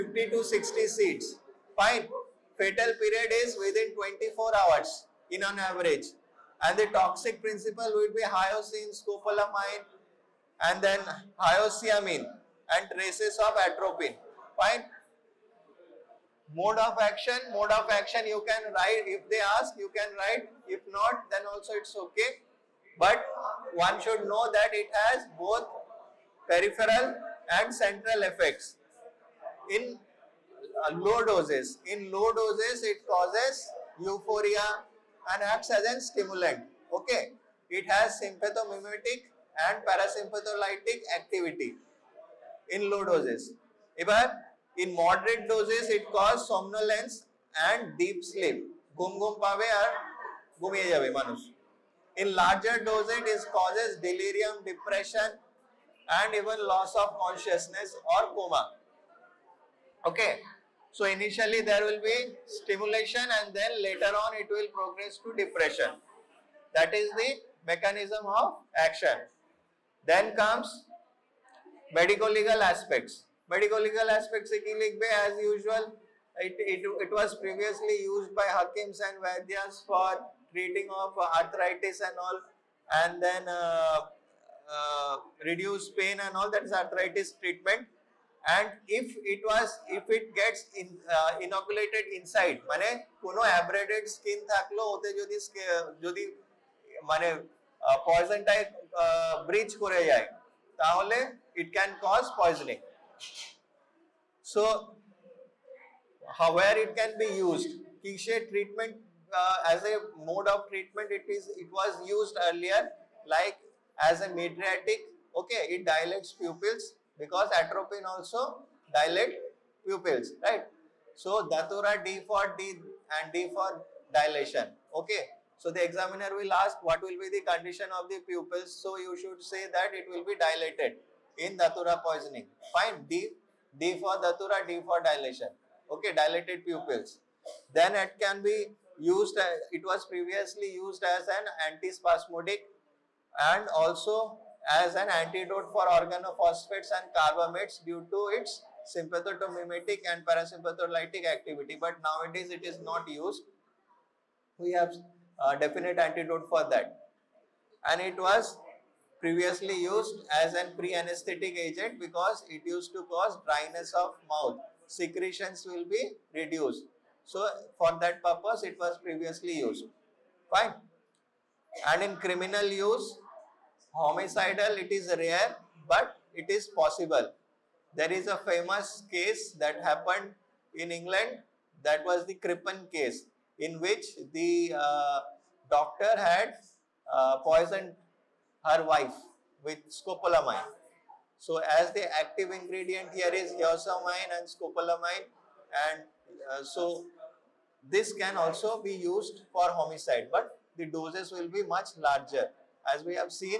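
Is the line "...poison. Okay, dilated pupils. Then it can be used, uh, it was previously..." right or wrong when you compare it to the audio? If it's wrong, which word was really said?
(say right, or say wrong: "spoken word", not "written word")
wrong: "dilation", not "poison".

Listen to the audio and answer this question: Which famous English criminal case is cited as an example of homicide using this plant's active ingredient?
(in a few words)
Crippen case.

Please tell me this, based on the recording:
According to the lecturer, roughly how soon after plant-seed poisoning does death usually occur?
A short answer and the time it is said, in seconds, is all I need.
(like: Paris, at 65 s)
24 hours, at 3 s.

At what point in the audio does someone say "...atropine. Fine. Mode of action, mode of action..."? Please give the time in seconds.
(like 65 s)
13 s.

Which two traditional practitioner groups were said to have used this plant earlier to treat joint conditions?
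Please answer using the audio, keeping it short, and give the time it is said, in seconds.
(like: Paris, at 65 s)
Hakims and Vaidyas, at 78 s.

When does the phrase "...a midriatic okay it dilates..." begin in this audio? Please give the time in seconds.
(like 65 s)
114 s.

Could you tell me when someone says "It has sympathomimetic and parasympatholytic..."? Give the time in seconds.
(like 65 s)
37 s.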